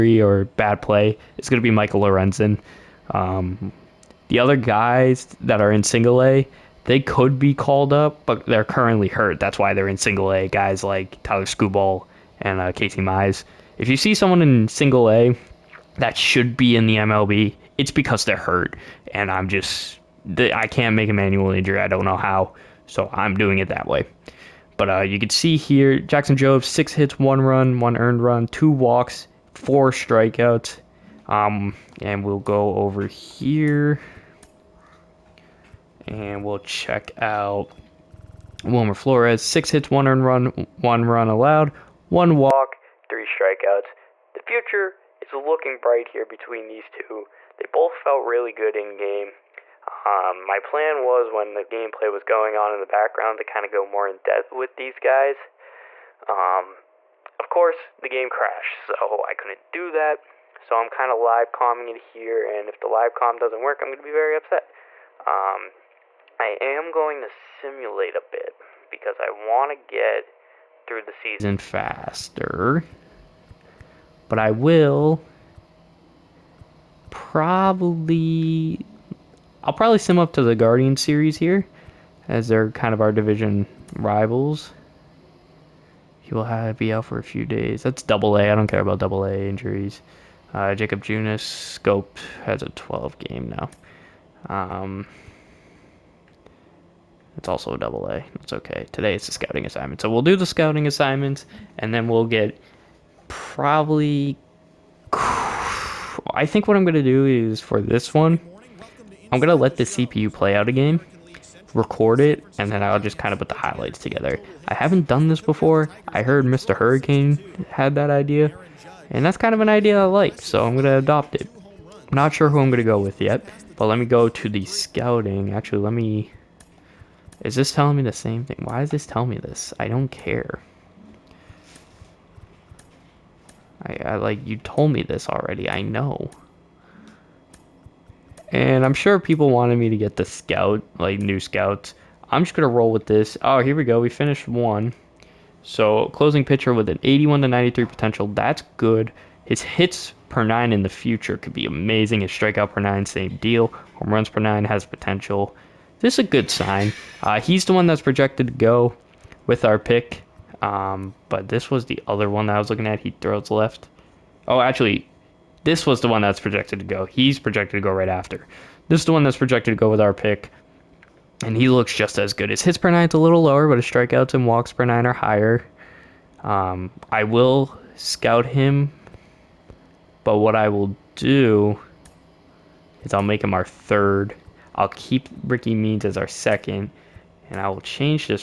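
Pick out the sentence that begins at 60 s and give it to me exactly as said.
So I'm kind of live comming it here, and if the live com doesn't work, I'm going to be very upset.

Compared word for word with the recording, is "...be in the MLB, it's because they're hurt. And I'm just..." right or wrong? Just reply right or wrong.
right.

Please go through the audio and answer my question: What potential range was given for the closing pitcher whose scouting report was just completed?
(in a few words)
81 to 93.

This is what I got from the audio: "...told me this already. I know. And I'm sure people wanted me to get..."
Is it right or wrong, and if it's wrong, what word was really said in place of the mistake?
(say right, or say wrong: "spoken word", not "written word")
right.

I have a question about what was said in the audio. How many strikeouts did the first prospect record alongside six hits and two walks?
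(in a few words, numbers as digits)
4.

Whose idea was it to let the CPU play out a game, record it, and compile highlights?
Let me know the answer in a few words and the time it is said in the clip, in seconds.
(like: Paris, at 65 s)
Mr. Hurricane, at 116 s.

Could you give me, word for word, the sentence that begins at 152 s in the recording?
His strikeout per nine, same deal.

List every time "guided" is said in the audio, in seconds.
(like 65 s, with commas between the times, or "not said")
not said.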